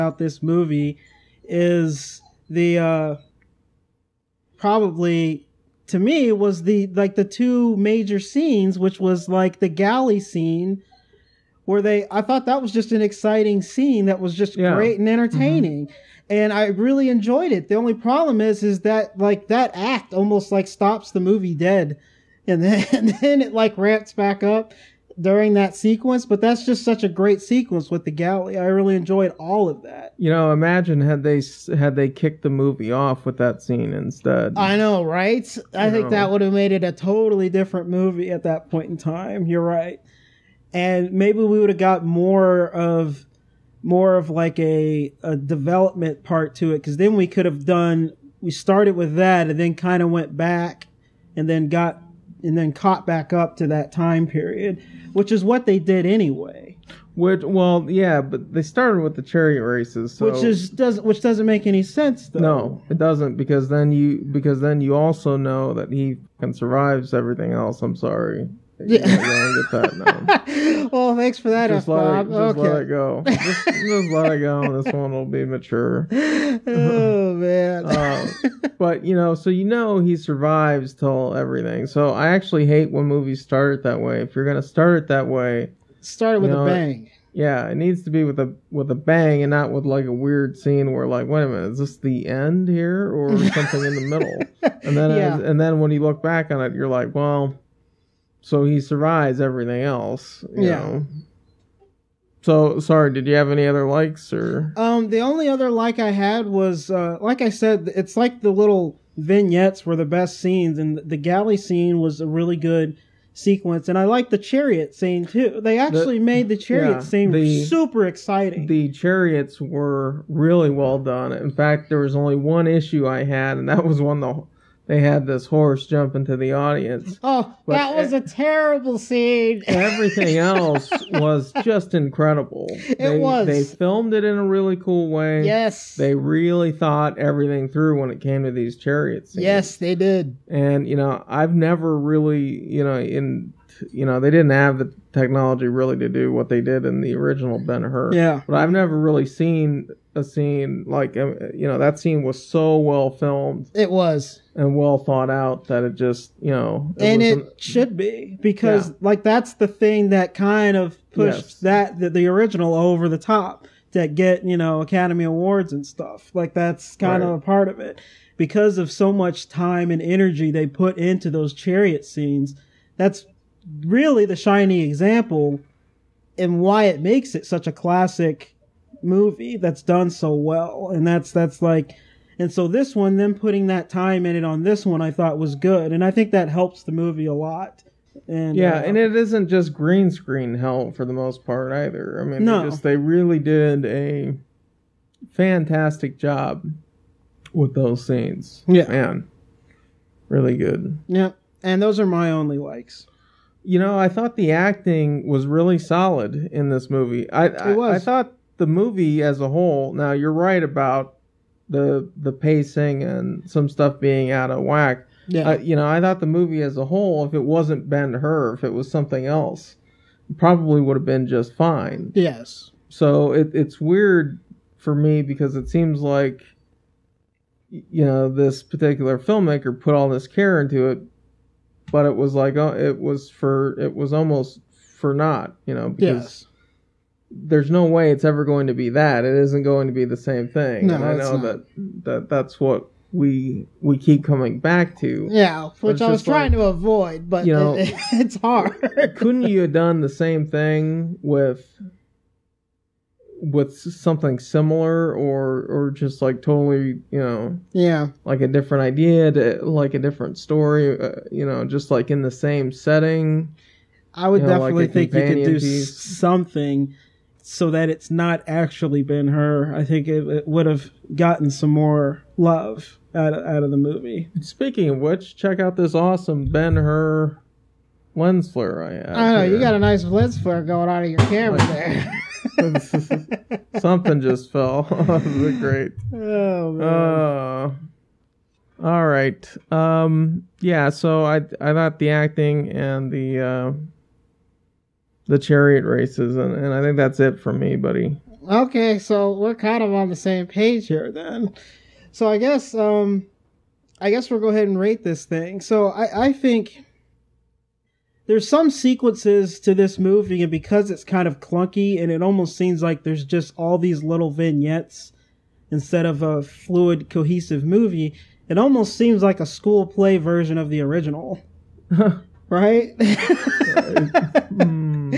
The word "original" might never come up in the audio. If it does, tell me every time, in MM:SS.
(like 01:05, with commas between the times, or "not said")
02:27, 02:42, 05:20.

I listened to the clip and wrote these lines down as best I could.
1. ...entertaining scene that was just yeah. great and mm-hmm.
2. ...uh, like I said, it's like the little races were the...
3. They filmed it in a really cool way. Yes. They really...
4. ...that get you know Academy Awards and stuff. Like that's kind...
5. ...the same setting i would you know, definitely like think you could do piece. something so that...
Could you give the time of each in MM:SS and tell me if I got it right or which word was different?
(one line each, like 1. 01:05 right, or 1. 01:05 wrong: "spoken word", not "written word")
1. 00:13 wrong: "exciting", not "entertaining"
2. 01:46 wrong: "vignettes", not "races"
3. 02:13 right
4. 02:43 right
5. 04:22 right.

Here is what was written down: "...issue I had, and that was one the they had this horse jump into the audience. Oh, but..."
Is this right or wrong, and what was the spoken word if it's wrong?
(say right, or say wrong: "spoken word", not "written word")
right.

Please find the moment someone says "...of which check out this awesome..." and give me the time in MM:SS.
04:34.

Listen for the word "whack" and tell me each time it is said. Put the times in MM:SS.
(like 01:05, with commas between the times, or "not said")
03:34.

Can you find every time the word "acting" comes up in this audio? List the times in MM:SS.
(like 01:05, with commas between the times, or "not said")
03:24, 04:52.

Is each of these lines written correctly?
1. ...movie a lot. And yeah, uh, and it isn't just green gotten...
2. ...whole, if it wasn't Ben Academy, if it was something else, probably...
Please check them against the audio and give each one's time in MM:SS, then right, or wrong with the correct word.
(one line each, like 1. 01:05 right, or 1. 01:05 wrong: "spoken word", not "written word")
1. 03:06 wrong: "screen", not "gotten"
2. 03:36 wrong: "Hur", not "Academy".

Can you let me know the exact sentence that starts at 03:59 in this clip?
It isn't going to be the same thing.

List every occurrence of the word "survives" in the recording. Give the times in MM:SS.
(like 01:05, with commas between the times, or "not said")
01:06, 01:20, 01:38.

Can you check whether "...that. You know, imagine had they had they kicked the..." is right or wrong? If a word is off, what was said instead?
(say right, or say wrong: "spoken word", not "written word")
right.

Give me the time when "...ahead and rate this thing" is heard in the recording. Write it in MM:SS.
05:04.